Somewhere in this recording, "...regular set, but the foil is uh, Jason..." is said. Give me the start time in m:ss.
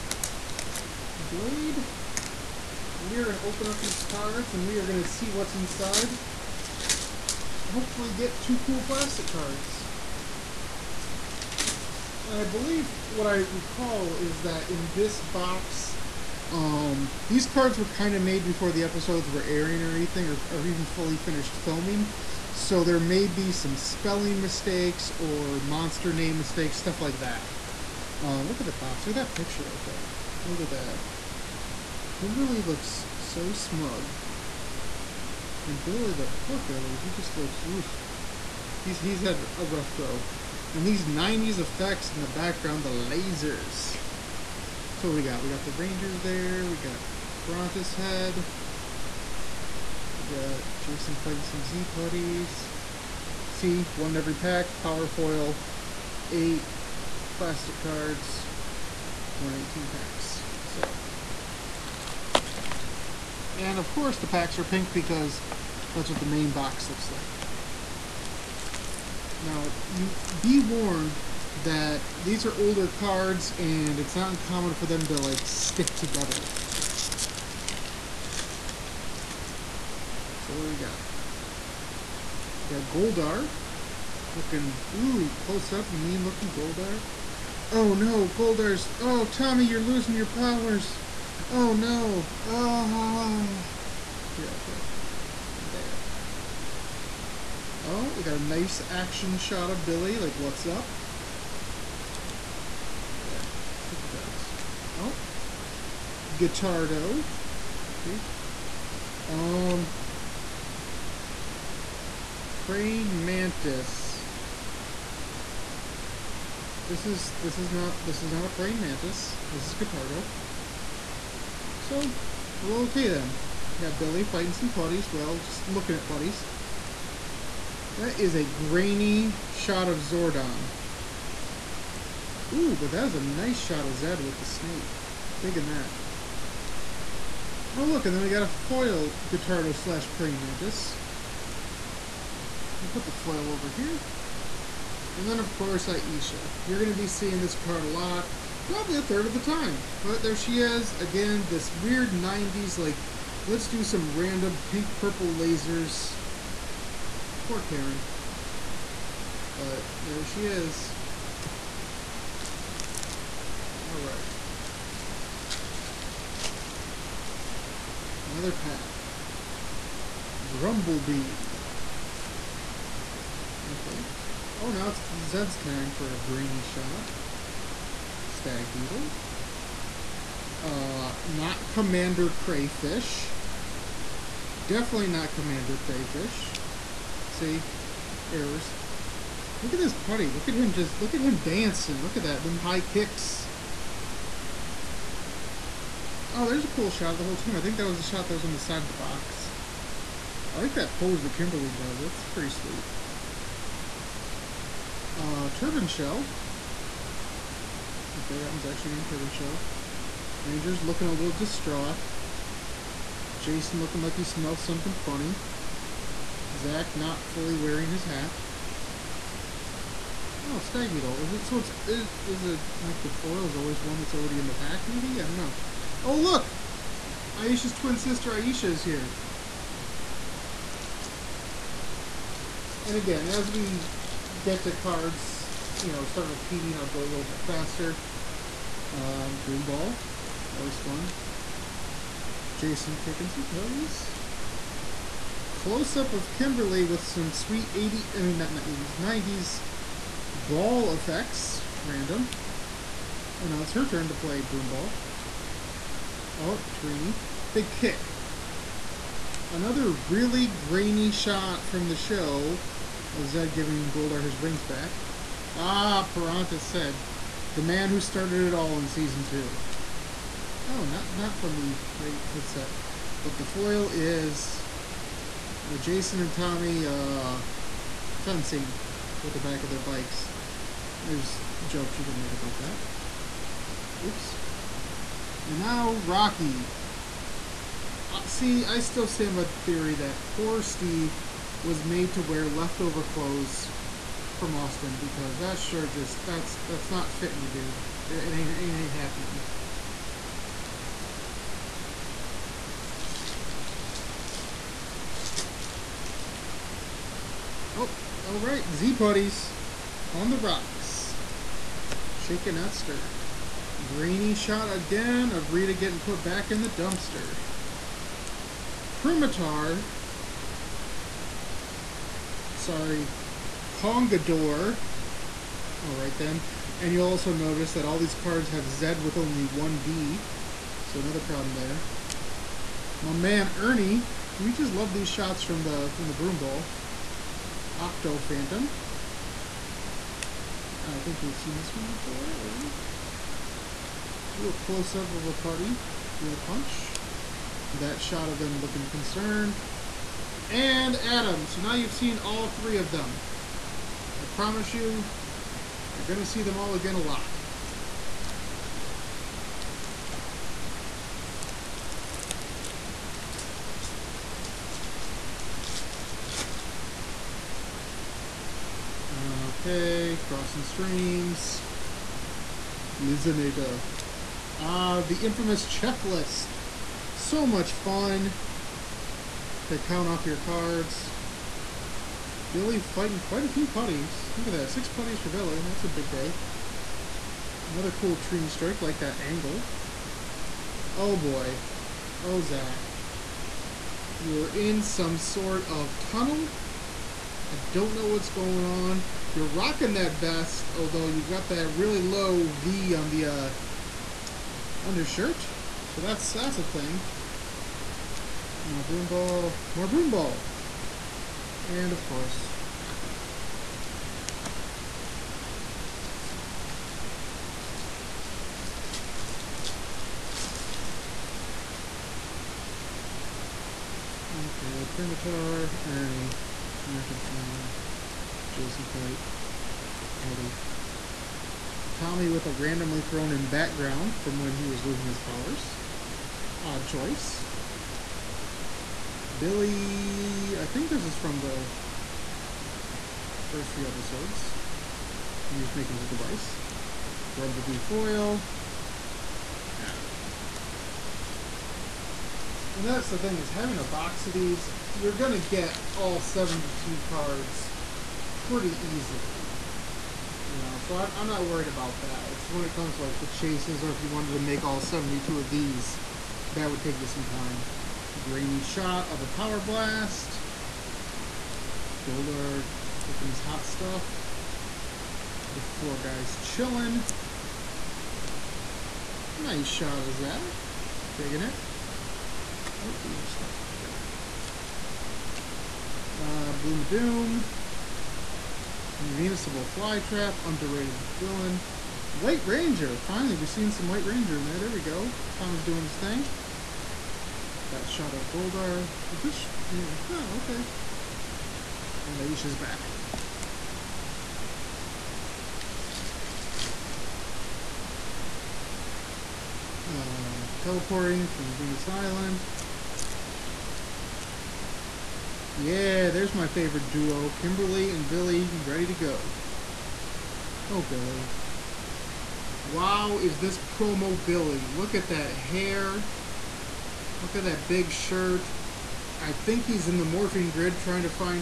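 4:31.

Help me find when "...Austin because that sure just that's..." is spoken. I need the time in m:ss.
4:54.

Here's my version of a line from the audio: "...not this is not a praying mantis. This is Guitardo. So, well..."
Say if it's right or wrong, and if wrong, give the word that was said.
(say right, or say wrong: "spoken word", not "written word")
right.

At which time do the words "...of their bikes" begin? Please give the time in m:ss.
4:39.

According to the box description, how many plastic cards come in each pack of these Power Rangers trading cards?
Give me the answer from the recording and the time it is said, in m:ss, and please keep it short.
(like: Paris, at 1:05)
8, at 0:56.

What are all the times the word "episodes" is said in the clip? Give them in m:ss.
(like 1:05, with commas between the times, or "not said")
0:18, 7:23.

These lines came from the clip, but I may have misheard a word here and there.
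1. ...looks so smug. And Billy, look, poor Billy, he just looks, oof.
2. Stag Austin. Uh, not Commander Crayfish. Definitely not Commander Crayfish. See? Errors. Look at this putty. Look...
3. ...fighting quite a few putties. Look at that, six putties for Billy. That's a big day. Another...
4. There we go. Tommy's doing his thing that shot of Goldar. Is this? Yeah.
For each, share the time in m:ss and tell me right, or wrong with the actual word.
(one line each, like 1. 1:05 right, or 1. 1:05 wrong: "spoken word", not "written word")
1. 0:32 right
2. 2:58 wrong: "Beetle", not "Austin"
3. 6:22 right
4. 8:14 right.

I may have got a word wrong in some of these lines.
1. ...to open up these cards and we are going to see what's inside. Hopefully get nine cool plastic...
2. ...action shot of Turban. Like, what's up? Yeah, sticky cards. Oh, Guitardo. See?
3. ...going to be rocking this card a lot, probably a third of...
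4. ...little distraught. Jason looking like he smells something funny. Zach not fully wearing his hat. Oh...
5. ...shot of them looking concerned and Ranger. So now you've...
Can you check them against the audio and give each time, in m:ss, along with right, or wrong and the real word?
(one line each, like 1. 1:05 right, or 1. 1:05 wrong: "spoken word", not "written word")
1. 0:03 wrong: "two", not "nine"
2. 1:38 wrong: "Billy", not "Turban"
3. 2:26 wrong: "seeing", not "rocking"
4. 3:31 right
5. 5:47 wrong: "Adam", not "Ranger".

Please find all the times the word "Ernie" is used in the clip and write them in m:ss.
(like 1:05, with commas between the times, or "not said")
5:33, 7:05.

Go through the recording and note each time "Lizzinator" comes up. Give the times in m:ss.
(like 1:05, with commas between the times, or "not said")
6:12.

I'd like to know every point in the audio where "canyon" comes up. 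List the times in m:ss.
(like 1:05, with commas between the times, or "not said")
not said.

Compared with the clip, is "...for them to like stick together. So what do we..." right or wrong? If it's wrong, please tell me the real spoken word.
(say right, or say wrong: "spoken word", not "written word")
right.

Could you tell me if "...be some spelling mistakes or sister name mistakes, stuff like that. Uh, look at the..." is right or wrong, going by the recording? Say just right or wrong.
wrong.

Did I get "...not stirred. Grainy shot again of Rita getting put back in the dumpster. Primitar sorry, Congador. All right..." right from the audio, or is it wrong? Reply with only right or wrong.
right.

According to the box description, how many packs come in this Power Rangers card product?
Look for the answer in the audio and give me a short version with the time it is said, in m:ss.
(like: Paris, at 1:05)
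118, at 0:59.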